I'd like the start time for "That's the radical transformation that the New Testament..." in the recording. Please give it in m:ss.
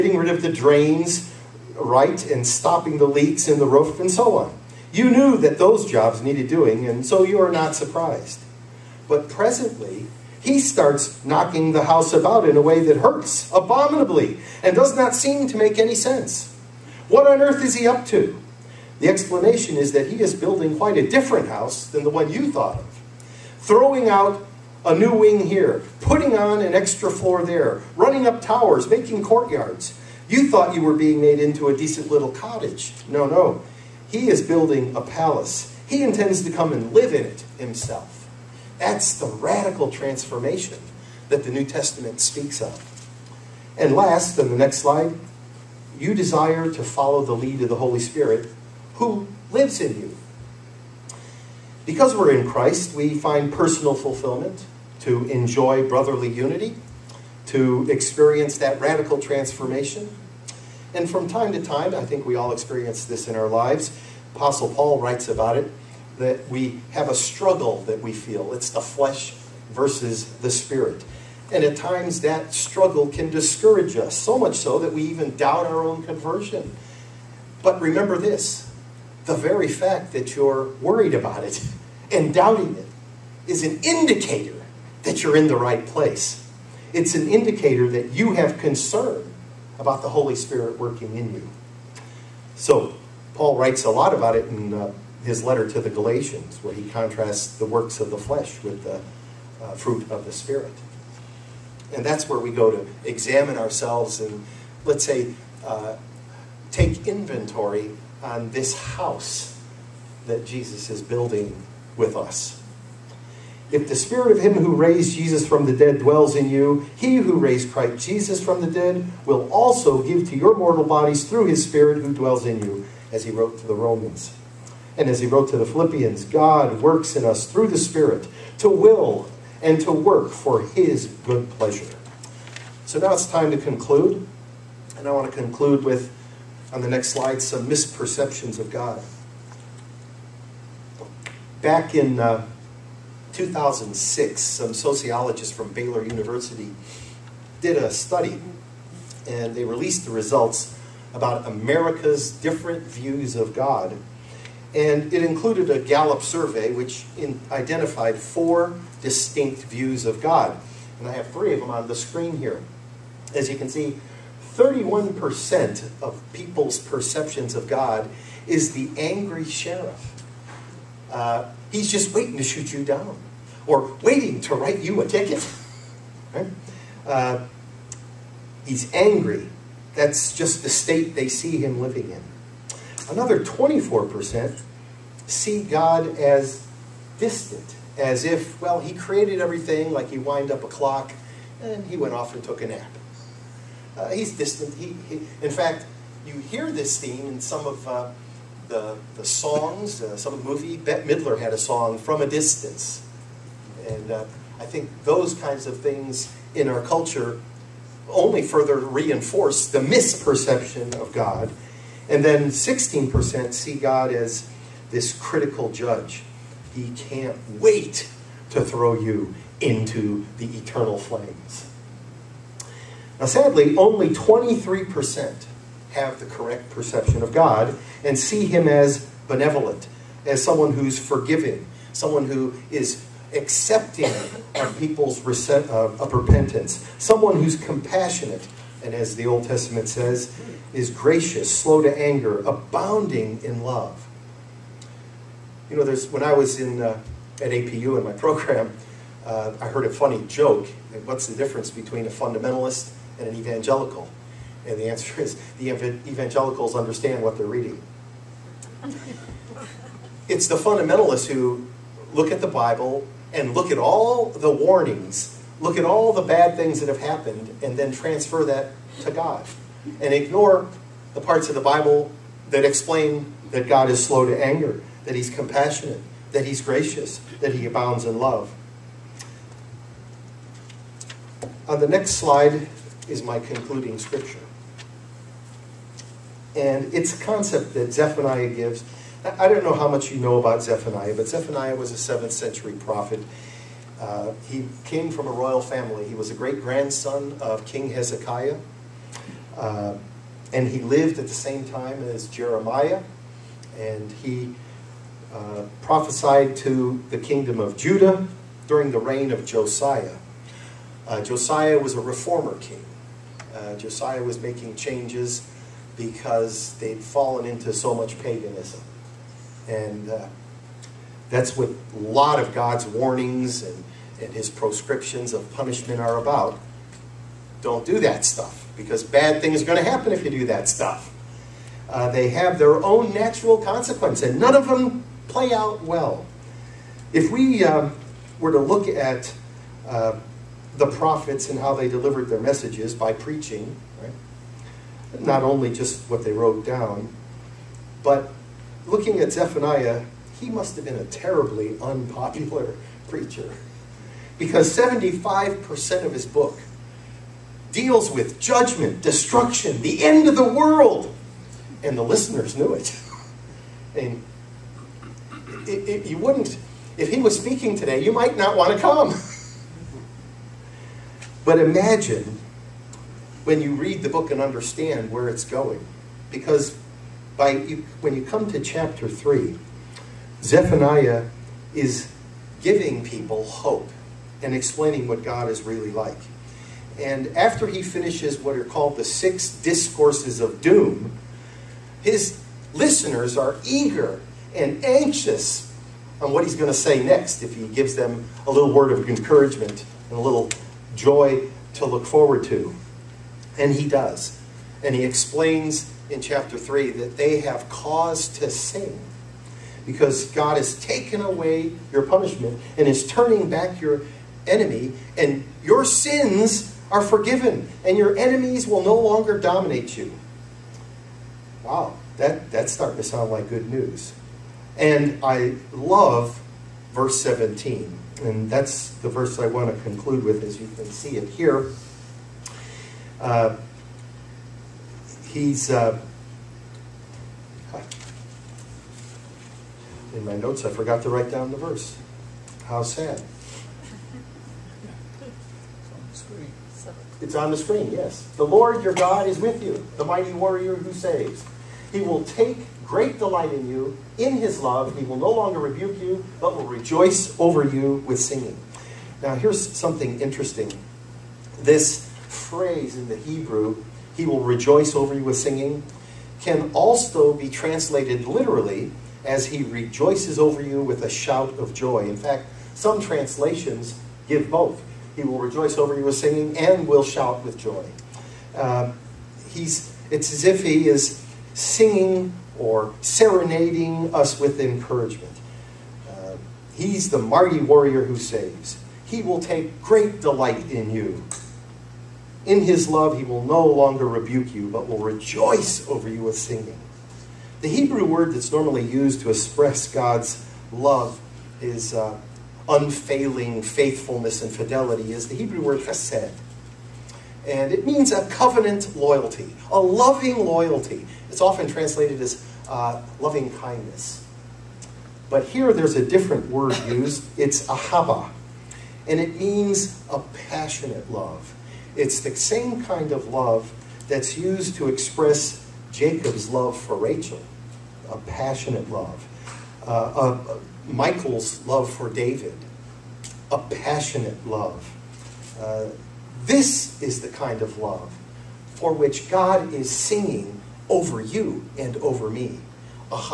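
0:38.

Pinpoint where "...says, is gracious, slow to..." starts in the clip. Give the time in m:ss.
3:59.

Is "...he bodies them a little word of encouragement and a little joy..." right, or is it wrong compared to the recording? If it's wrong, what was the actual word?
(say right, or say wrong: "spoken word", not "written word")
wrong: "gives", not "bodies".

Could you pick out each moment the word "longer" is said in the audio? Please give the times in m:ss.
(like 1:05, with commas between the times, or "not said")
6:58, 7:35, 8:13.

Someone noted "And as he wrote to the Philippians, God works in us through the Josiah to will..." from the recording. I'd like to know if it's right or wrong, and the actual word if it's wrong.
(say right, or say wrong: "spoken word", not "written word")
wrong: "Spirit", not "Josiah".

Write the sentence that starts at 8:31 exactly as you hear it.
It's often translated as uh, loving kindness.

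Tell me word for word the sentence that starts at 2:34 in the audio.
And it included a Gallup survey, which in, identified four distinct views of God.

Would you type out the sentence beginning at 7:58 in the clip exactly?
Uh, he's, it's as if he is singing or serenading us with encouragement.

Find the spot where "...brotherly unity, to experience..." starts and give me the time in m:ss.
0:55.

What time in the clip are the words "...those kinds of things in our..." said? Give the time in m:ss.
3:25.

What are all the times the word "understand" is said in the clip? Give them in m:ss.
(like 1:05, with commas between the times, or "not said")
4:16, 6:14.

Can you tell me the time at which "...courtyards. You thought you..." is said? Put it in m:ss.
0:29.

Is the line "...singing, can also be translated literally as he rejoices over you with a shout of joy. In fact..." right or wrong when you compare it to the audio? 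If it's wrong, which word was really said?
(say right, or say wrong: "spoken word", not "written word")
right.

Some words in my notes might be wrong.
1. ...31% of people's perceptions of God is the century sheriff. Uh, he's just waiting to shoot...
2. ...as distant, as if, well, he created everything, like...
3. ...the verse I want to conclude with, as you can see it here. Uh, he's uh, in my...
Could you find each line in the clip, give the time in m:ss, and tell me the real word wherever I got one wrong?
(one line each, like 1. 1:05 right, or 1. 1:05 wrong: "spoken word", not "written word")
1. 2:44 wrong: "angry", not "century"
2. 3:06 right
3. 7:08 right.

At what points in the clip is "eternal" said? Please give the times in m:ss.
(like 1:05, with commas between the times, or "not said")
3:40.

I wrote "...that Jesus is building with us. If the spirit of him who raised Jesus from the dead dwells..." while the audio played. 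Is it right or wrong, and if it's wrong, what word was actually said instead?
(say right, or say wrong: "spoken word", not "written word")
right.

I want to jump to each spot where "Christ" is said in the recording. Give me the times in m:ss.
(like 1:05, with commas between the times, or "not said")
0:52, 1:57.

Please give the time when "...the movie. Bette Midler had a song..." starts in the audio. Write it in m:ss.
3:20.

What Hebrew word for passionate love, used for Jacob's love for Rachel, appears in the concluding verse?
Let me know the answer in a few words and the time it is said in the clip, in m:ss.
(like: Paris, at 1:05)
ahaba, at 8:37.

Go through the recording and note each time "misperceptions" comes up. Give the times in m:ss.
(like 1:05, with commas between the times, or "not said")
2:17, 3:29.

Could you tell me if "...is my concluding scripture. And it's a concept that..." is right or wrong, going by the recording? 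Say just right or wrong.
right.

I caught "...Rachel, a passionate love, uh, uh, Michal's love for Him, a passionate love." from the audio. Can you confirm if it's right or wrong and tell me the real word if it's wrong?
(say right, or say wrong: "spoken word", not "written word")
wrong: "David", not "Him".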